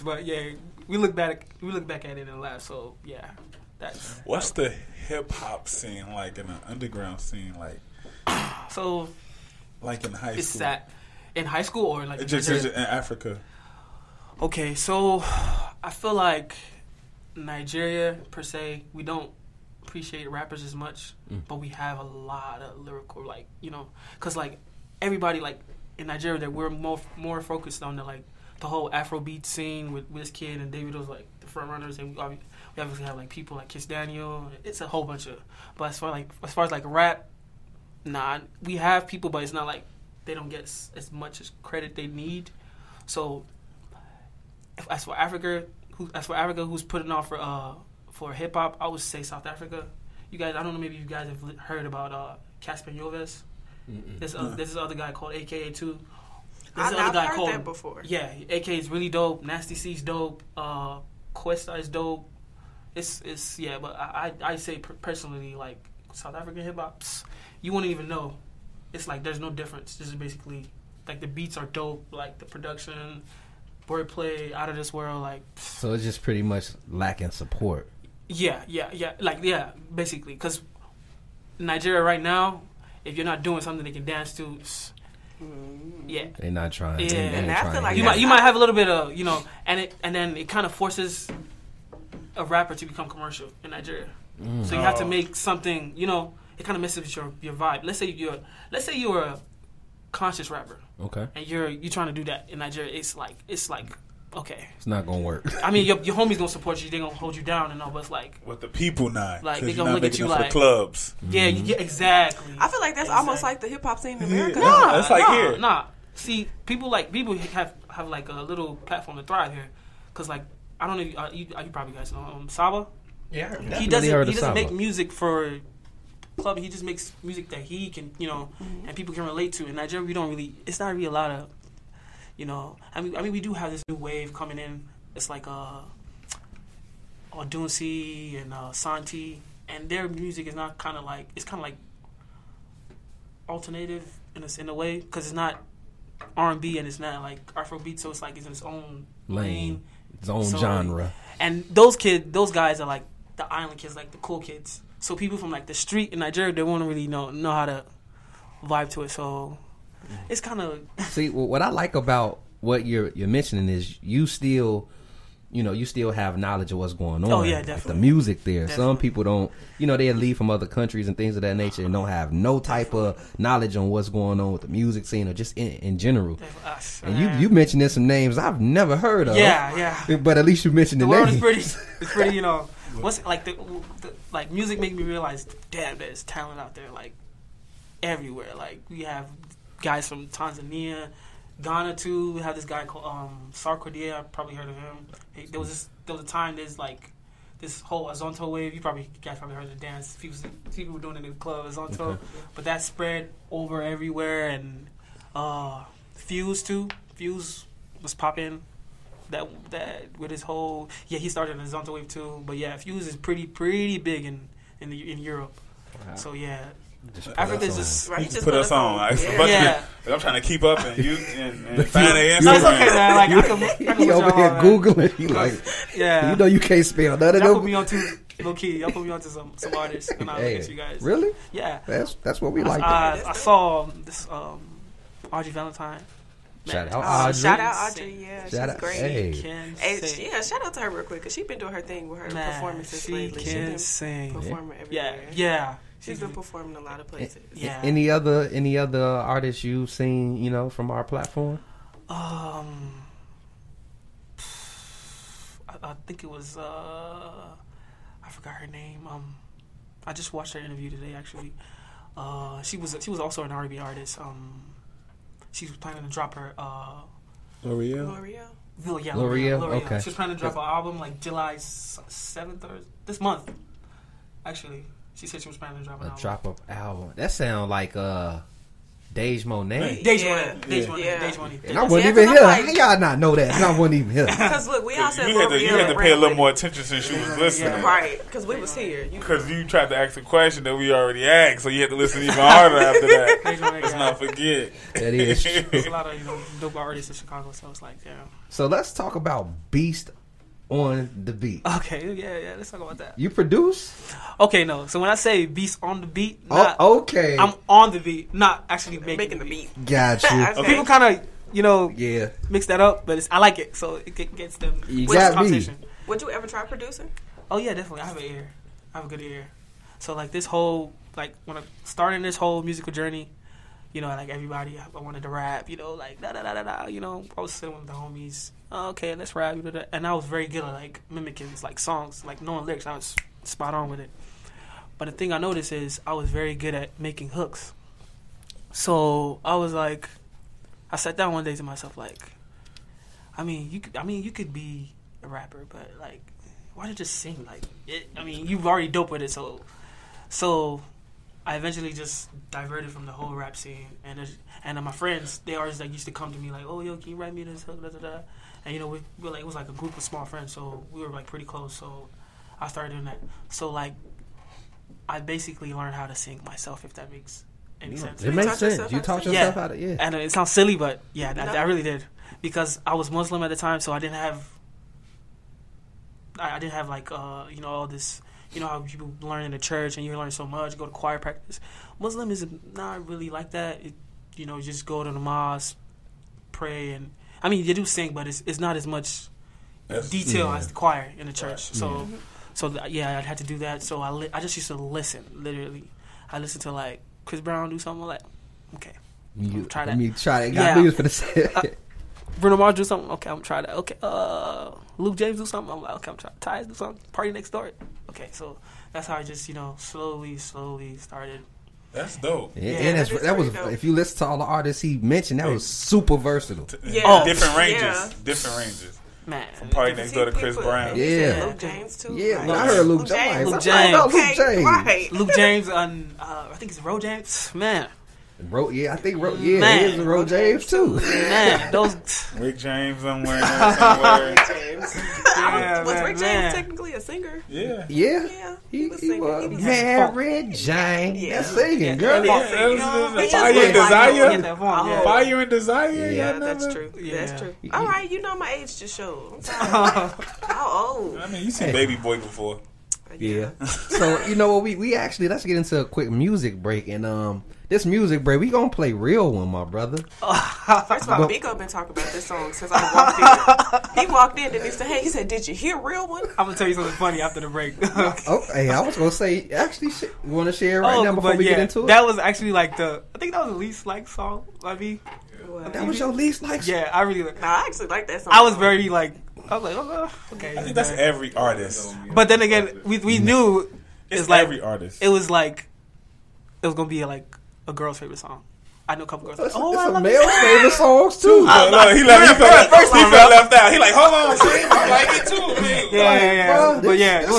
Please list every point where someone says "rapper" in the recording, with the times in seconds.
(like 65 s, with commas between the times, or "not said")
20 s, 92 s, 100 s, 345 s.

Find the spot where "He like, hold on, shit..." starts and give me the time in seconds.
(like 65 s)
493 s.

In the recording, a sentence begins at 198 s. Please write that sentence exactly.
You probably you guys probably heard the dance.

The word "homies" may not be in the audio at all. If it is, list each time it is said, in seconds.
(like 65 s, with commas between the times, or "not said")
106 s, 327 s.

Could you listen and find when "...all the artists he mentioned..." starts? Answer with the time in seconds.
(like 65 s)
414 s.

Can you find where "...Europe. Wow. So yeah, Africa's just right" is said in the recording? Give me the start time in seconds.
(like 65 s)
215 s.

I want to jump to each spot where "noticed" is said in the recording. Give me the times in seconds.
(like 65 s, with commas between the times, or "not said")
335 s.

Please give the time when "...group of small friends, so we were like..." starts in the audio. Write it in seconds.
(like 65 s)
359 s.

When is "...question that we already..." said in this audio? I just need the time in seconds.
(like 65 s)
290 s.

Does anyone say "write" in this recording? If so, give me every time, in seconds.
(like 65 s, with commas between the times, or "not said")
357 s.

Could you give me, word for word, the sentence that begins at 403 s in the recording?
Okay, uh, Luke James do something.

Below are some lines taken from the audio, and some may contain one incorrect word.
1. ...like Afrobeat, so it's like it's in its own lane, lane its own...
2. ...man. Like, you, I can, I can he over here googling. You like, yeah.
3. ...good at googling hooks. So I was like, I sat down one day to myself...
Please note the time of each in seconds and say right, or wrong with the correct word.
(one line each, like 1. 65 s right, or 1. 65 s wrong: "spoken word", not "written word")
1. 147 s right
2. 222 s right
3. 336 s wrong: "making", not "googling".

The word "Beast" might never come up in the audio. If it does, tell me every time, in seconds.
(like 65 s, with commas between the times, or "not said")
299 s.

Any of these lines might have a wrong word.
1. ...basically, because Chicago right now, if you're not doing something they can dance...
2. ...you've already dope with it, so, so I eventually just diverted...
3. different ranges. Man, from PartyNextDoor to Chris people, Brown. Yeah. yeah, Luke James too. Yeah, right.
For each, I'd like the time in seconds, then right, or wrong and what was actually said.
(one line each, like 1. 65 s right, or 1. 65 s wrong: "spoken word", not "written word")
1. 79 s wrong: "Nigeria", not "Chicago"
2. 348 s right
3. 418 s right.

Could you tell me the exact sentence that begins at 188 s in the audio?
Like we have guys from Tanzania, Ghana too.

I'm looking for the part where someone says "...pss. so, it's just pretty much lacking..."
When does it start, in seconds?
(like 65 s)
75 s.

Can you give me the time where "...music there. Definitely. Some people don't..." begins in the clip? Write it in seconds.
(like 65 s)
167 s.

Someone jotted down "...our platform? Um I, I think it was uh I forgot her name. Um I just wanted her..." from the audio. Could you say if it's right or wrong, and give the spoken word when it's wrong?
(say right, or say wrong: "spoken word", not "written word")
wrong: "watched", not "wanted".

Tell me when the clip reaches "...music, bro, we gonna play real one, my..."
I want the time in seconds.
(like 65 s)
457 s.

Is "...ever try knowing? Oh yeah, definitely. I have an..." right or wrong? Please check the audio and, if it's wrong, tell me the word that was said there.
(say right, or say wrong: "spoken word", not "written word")
wrong: "producing", not "knowing".